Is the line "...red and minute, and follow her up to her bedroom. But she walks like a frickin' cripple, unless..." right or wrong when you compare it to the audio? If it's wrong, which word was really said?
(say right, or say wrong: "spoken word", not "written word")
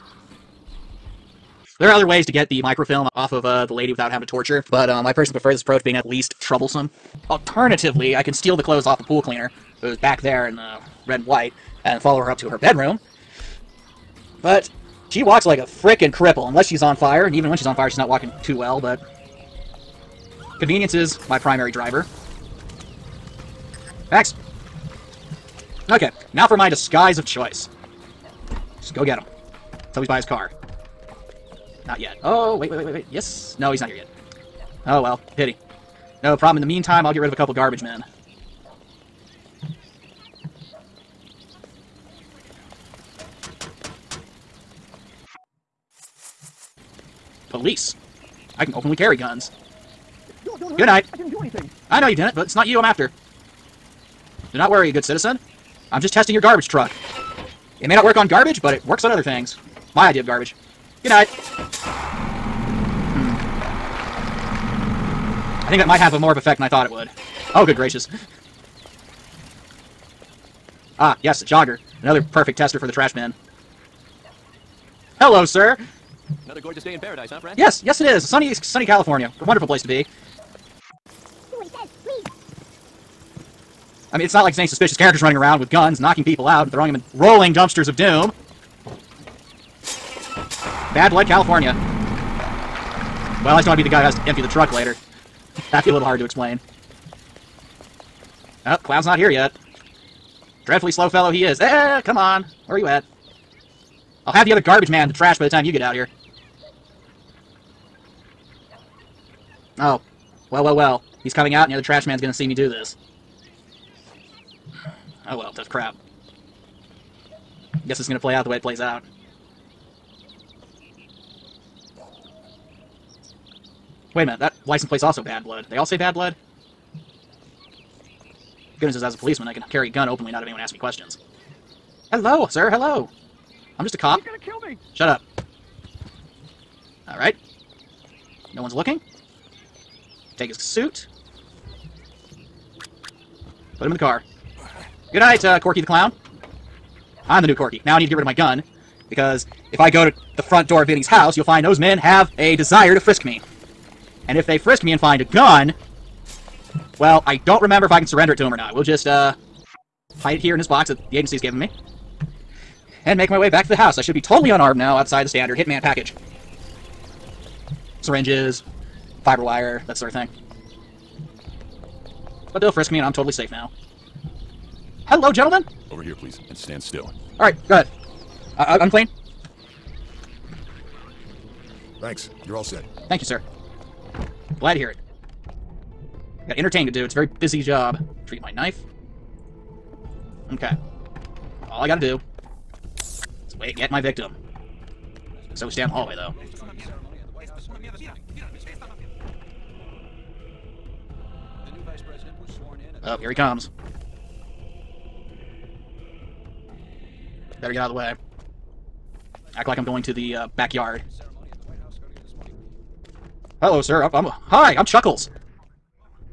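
wrong: "white", not "minute".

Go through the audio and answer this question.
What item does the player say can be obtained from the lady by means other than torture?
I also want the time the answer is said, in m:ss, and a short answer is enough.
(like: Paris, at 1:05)
microfilm, at 0:02.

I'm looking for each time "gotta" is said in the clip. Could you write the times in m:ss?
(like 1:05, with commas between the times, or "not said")
3:11.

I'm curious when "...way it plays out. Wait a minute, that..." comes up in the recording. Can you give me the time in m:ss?
1:58.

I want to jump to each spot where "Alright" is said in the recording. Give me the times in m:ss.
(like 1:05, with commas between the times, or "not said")
2:17, 2:57.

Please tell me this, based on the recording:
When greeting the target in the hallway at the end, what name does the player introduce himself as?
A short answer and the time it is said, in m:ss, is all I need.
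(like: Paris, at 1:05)
Chuckles, at 3:34.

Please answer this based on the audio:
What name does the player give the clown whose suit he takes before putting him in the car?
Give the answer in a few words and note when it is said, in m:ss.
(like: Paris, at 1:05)
Corky the Clown, at 2:25.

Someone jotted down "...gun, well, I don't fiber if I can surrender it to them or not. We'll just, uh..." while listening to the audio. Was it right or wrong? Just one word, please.
wrong.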